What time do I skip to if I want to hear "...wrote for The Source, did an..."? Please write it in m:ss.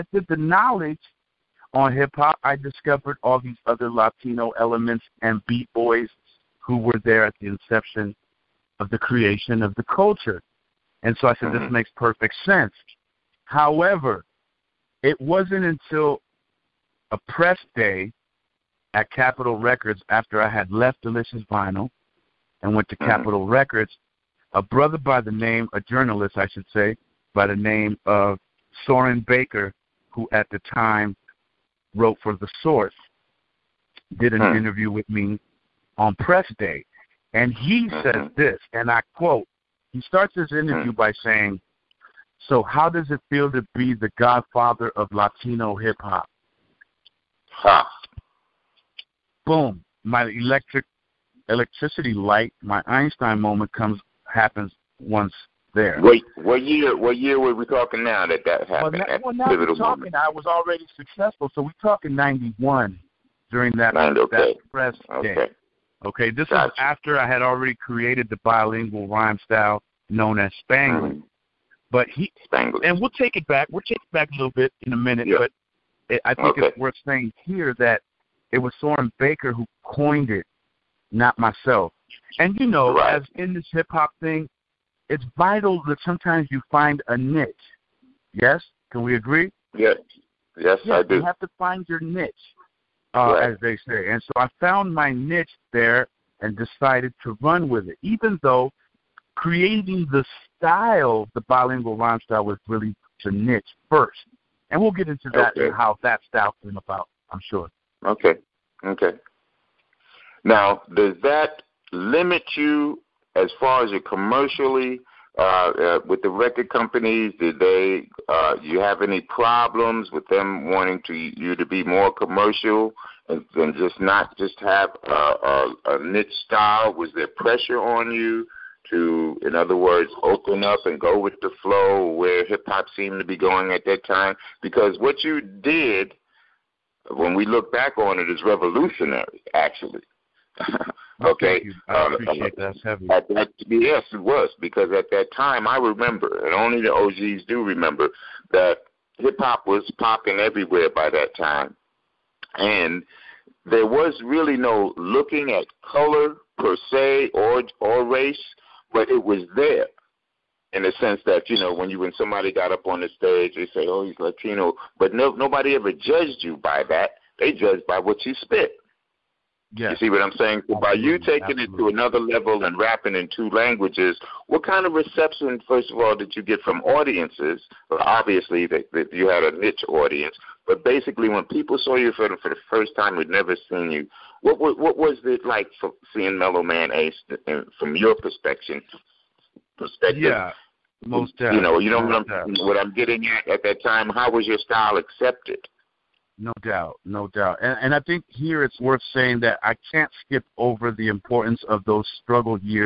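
0:31.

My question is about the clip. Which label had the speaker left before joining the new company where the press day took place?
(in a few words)
Delicious Vinyl.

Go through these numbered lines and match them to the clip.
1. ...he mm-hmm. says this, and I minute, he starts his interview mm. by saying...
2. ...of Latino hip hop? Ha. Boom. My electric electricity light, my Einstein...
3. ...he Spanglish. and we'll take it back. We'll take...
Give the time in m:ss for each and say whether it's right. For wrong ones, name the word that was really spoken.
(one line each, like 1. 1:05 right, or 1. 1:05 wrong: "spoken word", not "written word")
1. 0:37 wrong: "quote", not "minute"
2. 0:44 right
3. 1:12 right.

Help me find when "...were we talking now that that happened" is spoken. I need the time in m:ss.
0:57.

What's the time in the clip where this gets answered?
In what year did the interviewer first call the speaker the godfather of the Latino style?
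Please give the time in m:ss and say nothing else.
1:02.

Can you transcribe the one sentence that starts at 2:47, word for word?
They judged by what you spit.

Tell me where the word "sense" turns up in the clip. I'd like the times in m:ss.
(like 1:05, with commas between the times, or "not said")
0:12, 2:40.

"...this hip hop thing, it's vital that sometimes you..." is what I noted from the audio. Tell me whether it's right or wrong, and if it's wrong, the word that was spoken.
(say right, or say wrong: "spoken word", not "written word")
right.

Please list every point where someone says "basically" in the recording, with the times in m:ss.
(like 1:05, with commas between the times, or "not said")
3:00.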